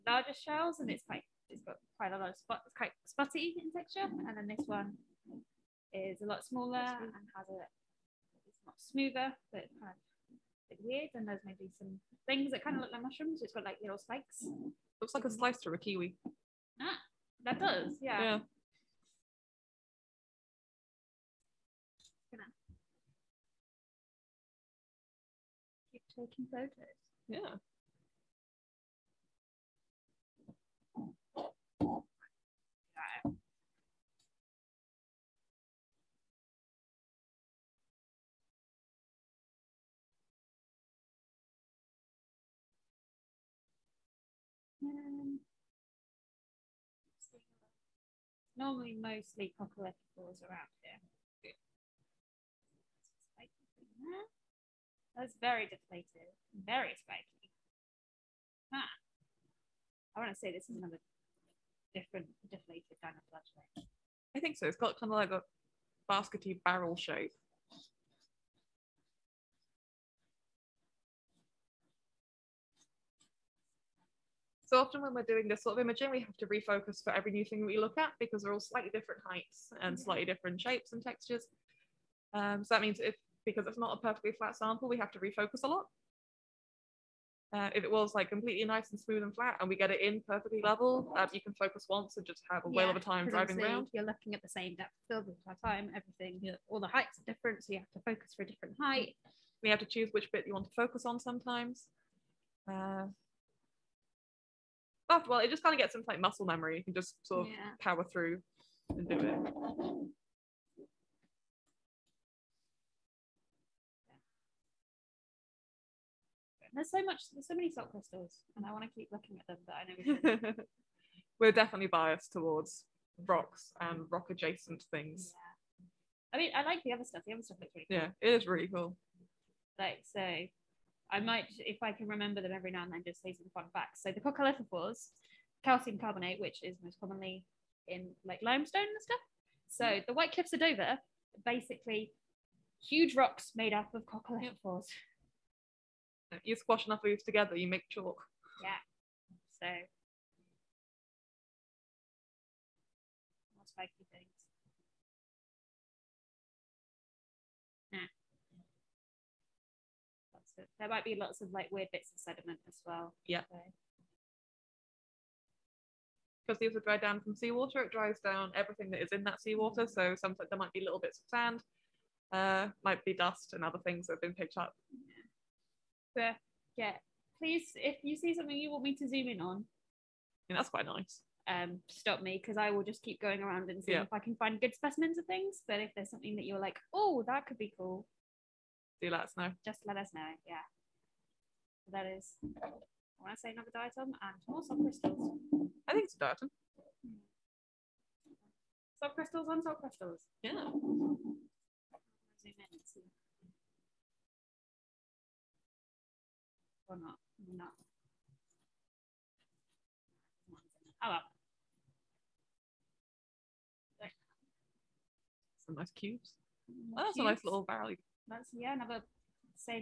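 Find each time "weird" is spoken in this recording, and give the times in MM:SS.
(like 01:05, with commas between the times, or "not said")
00:10, 02:41.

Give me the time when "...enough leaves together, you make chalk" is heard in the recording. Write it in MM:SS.
02:26.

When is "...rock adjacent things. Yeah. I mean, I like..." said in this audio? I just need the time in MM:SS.
02:04.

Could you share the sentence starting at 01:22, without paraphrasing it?
Um, so that means if because it's not a perfectly flat sample, we have to refocus a lot.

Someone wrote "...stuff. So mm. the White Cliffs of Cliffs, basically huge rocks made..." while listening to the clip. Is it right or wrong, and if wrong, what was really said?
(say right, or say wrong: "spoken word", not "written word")
wrong: "Dover", not "Cliffs".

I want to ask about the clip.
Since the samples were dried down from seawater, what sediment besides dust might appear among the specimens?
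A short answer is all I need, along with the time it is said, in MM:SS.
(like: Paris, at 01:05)
Sand, at 02:51.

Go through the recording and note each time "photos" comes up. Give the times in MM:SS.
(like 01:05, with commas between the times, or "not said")
00:26.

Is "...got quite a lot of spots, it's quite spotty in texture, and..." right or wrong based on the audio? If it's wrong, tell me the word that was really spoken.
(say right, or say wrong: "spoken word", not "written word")
right.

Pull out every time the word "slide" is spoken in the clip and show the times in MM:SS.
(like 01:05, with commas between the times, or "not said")
not said.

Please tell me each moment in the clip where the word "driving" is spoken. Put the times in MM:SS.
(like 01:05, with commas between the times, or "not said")
01:33.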